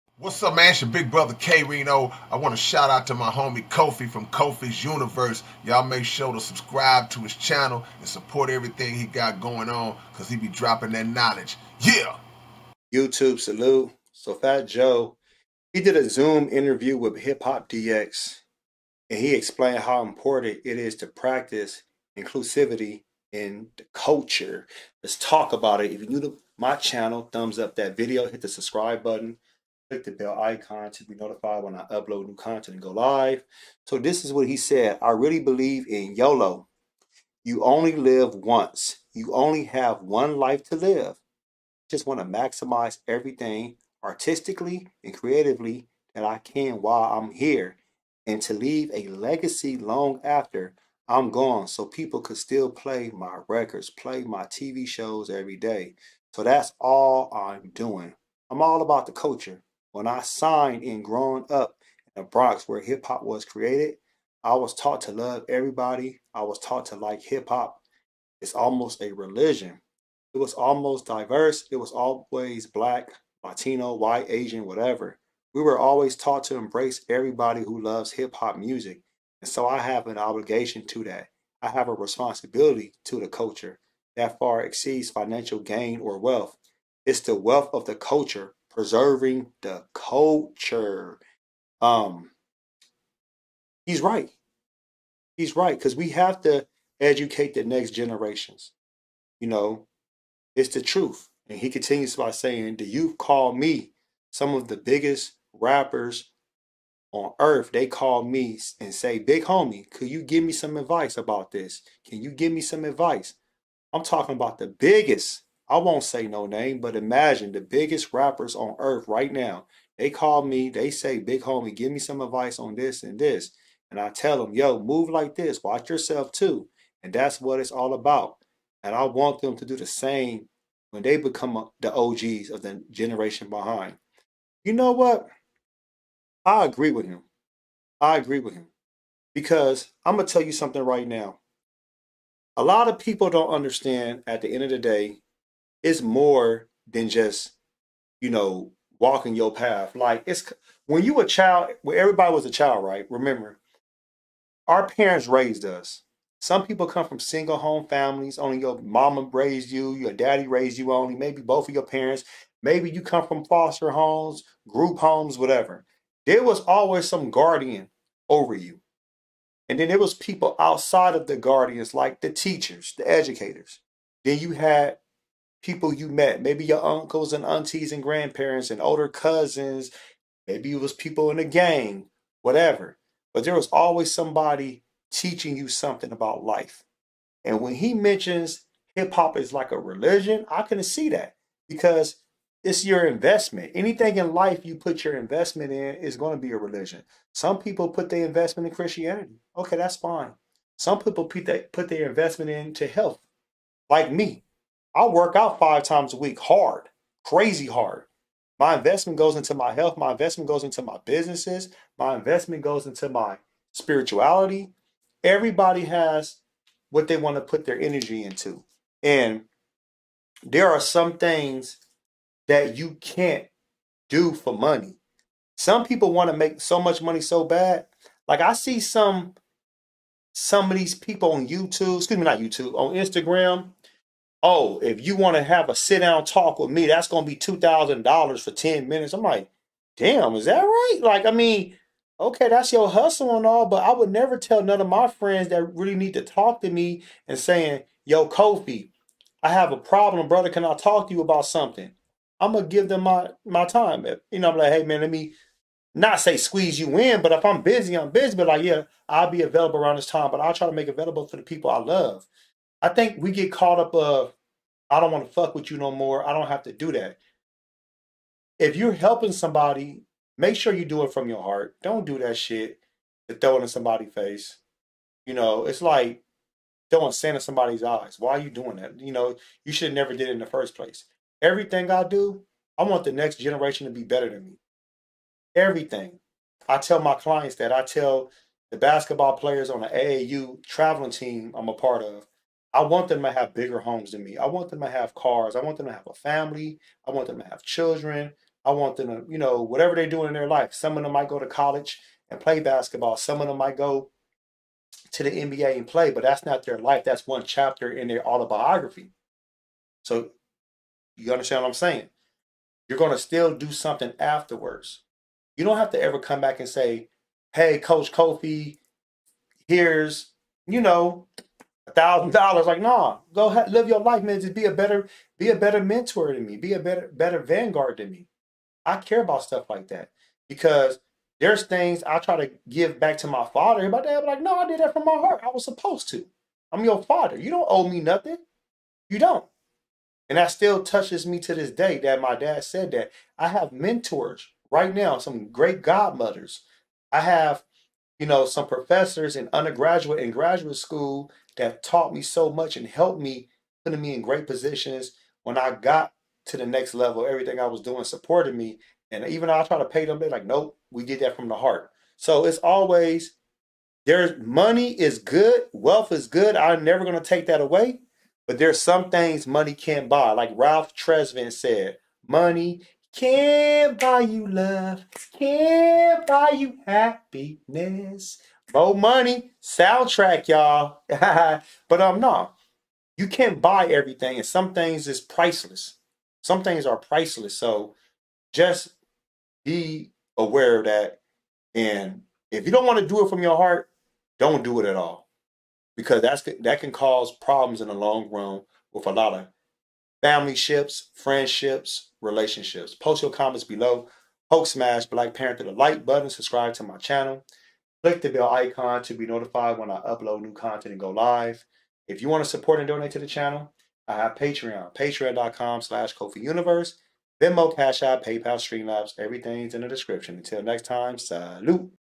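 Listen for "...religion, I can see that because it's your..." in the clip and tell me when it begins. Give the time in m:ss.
3:09.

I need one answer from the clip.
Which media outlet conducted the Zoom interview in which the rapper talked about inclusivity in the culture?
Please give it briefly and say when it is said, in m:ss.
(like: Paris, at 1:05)
Hip Hop DX, at 0:17.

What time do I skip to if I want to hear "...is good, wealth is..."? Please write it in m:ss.
6:05.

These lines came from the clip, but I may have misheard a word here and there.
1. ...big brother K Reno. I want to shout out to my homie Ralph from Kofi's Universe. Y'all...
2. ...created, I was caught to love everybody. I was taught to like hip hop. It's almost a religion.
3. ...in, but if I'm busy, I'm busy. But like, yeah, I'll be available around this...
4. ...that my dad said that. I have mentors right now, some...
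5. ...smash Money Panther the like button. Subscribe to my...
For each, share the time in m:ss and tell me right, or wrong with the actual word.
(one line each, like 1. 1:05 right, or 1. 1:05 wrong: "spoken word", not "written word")
1. 0:00 wrong: "Kofi", not "Ralph"
2. 1:03 wrong: "taught", not "caught"
3. 4:16 right
4. 5:41 right
5. 6:44 wrong: "Black", not "Money".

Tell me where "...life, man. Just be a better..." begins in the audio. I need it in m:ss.
5:23.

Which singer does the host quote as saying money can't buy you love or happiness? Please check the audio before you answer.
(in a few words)
Ralph Tresvant.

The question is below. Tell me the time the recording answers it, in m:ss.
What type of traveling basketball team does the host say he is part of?
4:49.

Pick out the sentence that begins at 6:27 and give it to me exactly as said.
So just be aware of that.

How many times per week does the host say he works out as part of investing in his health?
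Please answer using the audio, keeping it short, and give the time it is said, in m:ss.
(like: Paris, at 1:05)
5, at 3:25.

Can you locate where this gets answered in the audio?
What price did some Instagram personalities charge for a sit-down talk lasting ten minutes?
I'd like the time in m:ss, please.
3:57.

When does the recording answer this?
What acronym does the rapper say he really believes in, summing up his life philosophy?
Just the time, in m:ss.
0:36.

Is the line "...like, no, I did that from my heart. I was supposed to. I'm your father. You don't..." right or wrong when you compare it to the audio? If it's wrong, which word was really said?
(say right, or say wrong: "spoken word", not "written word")
right.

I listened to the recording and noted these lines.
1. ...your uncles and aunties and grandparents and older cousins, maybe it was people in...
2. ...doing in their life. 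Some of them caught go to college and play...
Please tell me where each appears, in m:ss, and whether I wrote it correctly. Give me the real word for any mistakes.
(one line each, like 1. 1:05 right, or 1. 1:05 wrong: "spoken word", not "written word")
1. 2:56 right
2. 5:00 wrong: "might", not "caught".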